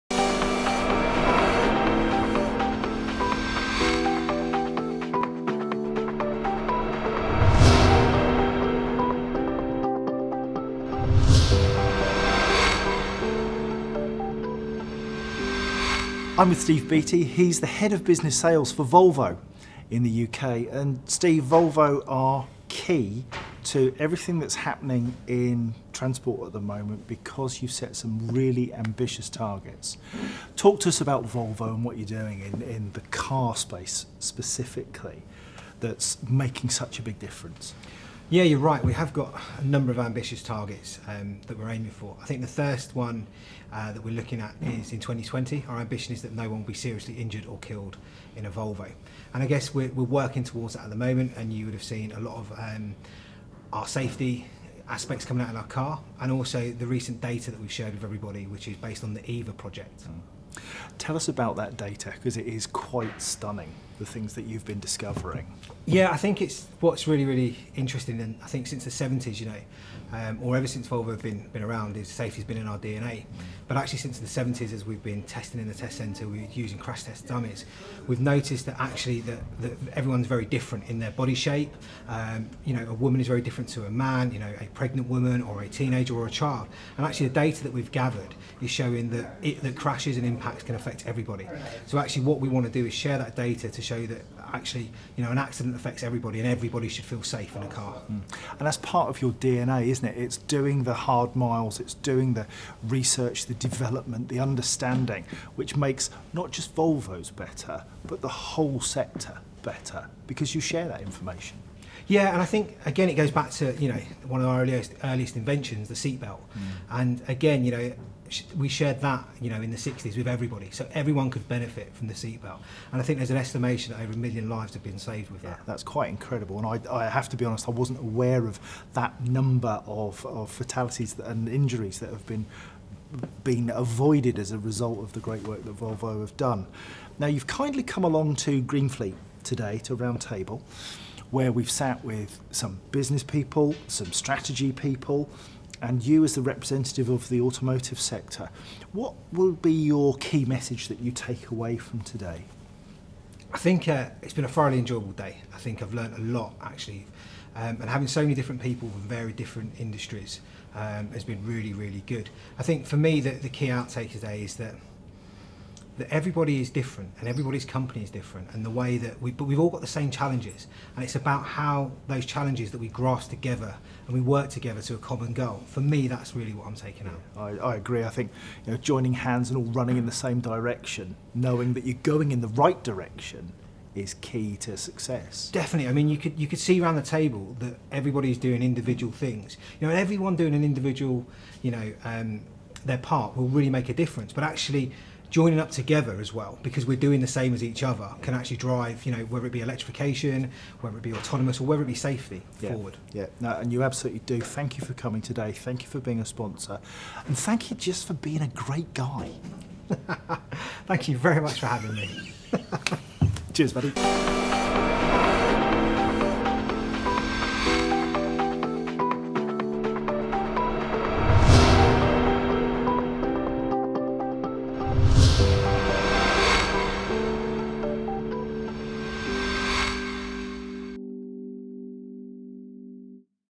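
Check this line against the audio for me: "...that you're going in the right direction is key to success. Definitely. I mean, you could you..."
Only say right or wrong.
right.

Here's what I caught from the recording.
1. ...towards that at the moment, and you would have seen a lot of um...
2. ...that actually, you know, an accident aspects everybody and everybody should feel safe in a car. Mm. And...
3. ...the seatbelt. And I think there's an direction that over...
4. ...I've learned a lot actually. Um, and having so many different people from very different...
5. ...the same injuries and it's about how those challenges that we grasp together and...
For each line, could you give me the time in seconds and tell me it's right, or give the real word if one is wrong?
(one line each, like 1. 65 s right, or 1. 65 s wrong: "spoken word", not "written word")
1. 50 s right
2. 94 s wrong: "affects", not "aspects"
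3. 122 s wrong: "estimation", not "direction"
4. 155 s right
5. 169 s wrong: "challenges", not "injuries".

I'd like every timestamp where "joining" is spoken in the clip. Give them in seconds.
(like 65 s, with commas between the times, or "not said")
178 s, 195 s.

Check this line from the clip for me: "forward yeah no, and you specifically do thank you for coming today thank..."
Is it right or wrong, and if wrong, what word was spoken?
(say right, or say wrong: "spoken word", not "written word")
wrong: "absolutely", not "specifically".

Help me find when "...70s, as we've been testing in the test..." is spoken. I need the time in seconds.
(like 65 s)
74 s.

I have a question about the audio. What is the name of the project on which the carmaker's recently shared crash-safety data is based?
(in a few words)
EVA project.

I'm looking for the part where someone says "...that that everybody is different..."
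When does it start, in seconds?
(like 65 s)
164 s.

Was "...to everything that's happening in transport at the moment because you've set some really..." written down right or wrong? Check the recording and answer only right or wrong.
right.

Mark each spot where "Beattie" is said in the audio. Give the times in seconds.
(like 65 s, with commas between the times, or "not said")
16 s.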